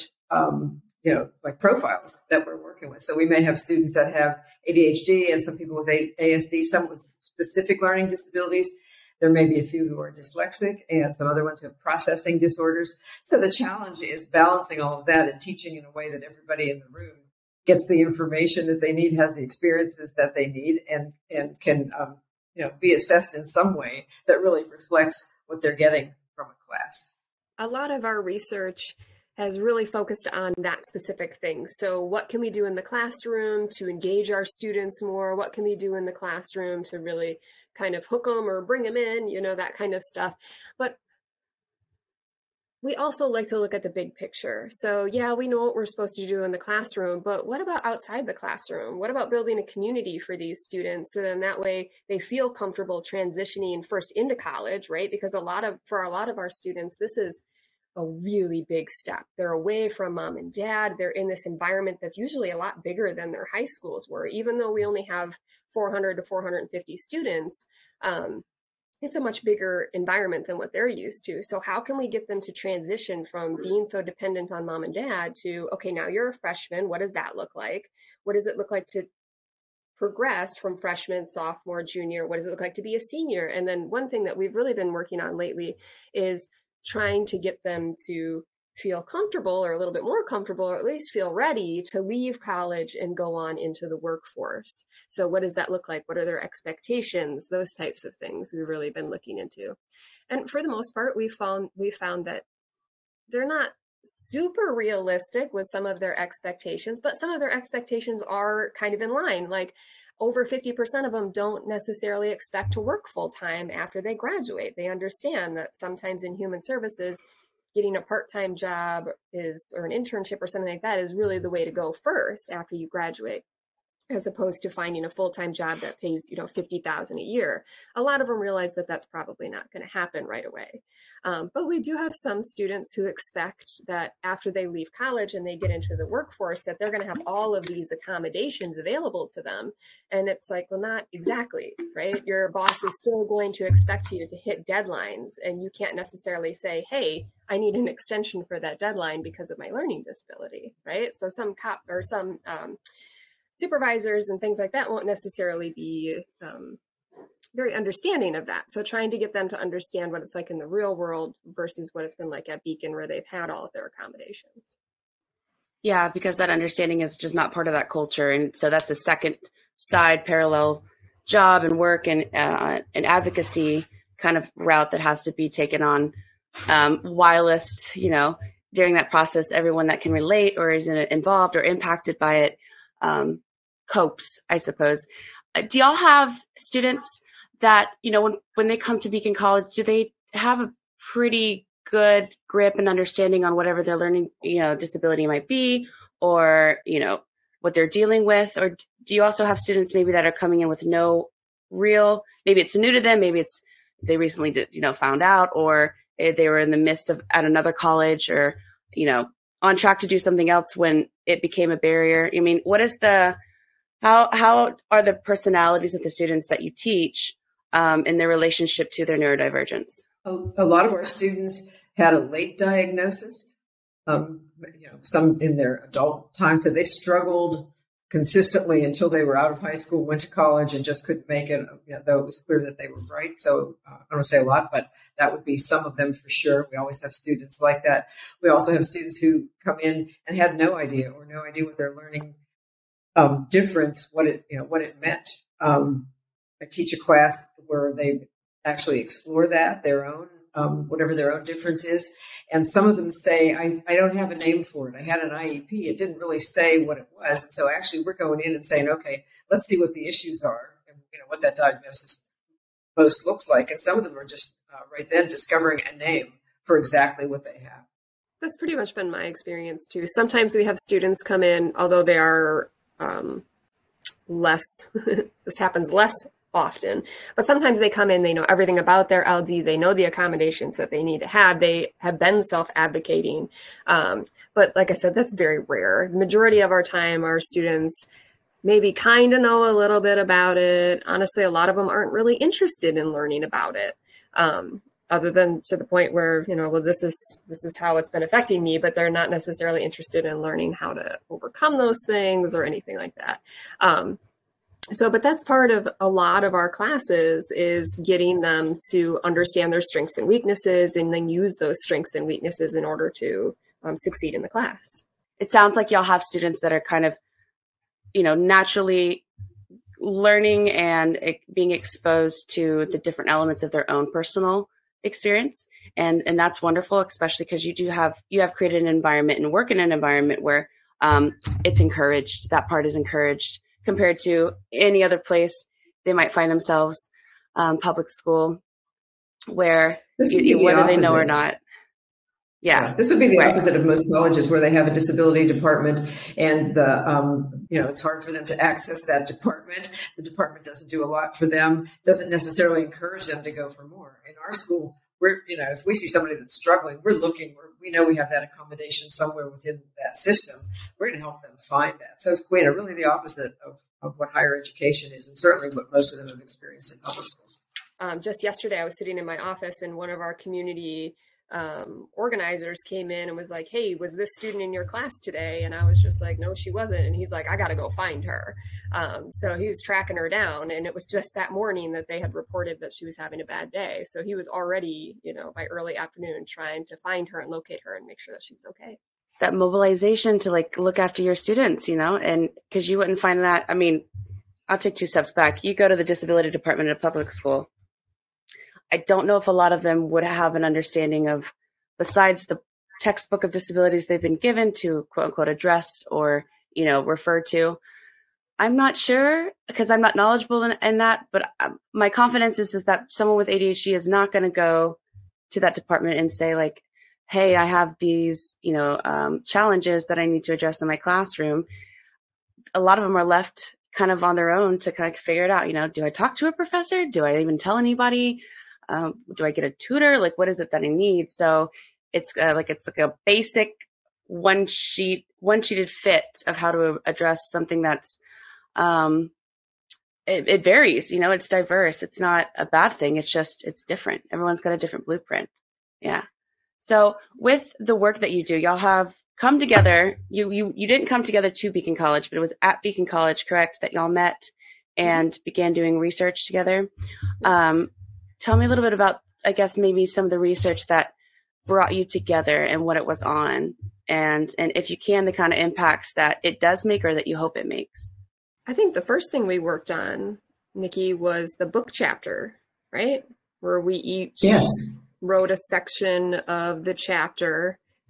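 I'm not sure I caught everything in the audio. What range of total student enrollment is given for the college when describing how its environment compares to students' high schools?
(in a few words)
400 to 450.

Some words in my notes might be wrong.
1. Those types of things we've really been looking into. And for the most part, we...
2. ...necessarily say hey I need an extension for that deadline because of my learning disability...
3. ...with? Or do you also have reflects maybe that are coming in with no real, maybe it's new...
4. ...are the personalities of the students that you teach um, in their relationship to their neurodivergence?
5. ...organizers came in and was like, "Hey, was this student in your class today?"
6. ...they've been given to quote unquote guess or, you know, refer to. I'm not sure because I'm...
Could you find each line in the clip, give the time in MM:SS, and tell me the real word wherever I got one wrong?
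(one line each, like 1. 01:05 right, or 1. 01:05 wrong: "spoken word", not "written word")
1. 01:37 right
2. 02:25 right
3. 03:18 wrong: "students", not "reflects"
4. 03:34 right
5. 06:12 right
6. 06:44 wrong: "address", not "guess".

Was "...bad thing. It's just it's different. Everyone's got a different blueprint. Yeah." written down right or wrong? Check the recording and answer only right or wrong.
right.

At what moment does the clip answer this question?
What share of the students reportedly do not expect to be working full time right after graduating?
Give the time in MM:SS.
01:50.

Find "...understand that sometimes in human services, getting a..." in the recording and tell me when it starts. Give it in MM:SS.
01:54.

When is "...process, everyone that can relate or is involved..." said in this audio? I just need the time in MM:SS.
02:59.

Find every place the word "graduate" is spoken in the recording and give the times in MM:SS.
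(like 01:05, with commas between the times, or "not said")
01:54, 02:02.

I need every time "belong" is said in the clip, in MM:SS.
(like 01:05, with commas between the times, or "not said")
not said.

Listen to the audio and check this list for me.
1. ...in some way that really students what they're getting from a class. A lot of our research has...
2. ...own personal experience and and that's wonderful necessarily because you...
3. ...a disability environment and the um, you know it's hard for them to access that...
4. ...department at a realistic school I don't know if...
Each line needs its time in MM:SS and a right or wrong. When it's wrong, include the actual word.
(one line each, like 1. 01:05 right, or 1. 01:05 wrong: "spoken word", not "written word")
1. 00:23 wrong: "reflects", not "students"
2. 05:23 wrong: "especially", not "necessarily"
3. 05:44 wrong: "department", not "environment"
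4. 06:36 wrong: "public", not "realistic".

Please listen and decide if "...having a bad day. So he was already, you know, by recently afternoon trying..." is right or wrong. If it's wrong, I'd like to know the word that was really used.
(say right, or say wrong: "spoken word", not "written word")
wrong: "early", not "recently".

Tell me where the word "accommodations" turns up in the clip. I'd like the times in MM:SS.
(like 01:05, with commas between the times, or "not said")
02:17, 02:43, 04:40, 05:58.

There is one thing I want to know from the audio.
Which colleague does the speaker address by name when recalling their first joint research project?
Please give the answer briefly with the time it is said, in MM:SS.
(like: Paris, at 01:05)
Nicki, at 07:50.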